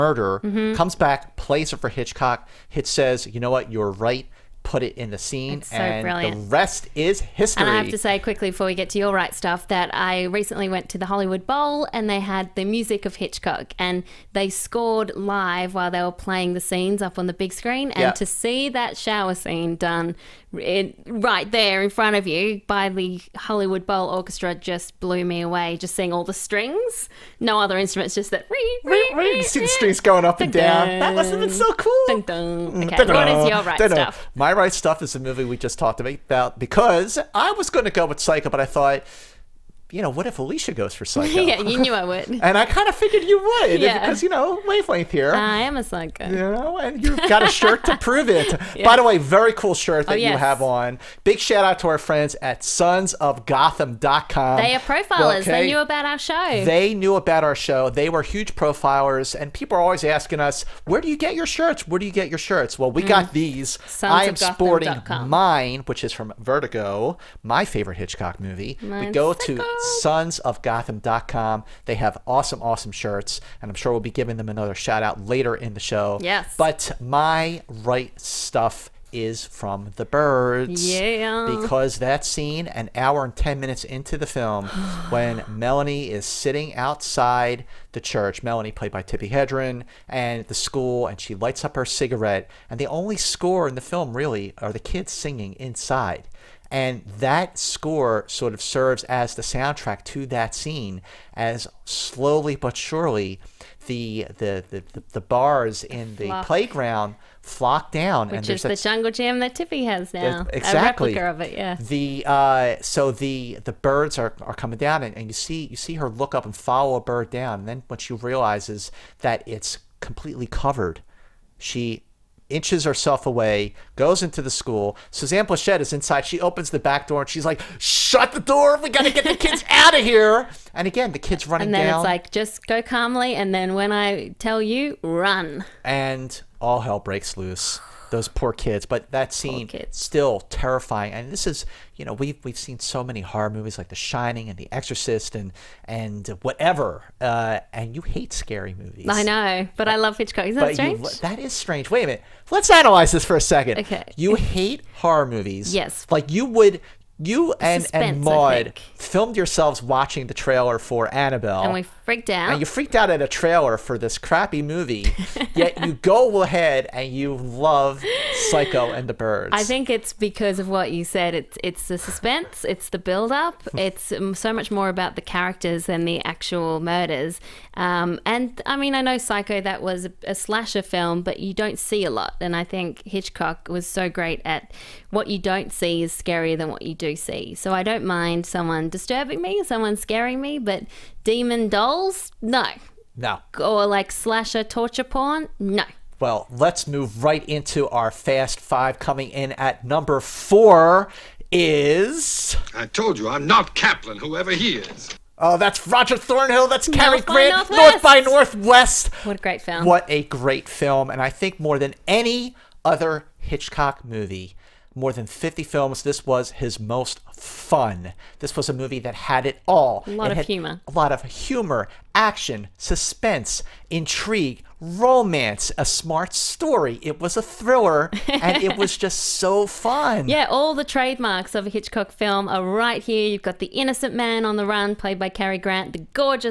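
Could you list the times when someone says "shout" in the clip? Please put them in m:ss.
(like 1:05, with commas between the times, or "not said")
0:51, 1:14.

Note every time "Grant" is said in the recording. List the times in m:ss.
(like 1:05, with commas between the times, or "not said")
3:27, 3:55.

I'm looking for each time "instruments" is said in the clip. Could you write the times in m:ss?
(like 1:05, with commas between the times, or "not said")
0:27.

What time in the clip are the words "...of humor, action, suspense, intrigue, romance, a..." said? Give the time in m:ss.
3:41.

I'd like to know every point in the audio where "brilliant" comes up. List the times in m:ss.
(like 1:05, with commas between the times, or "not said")
0:06.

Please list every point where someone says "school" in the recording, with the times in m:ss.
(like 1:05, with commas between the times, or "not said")
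1:30, 2:04.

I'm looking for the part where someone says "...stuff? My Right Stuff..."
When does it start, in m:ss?
0:33.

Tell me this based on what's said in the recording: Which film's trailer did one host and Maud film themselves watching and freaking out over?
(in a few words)
Annabelle.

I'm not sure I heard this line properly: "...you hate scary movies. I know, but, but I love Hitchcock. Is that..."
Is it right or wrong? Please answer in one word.
right.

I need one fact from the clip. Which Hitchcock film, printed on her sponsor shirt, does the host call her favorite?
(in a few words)
Vertigo.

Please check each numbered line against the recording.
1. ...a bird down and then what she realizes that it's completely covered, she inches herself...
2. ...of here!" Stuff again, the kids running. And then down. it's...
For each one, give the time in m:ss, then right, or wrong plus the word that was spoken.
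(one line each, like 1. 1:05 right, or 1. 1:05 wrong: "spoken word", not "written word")
1. 1:56 right
2. 2:09 wrong: "And", not "Stuff".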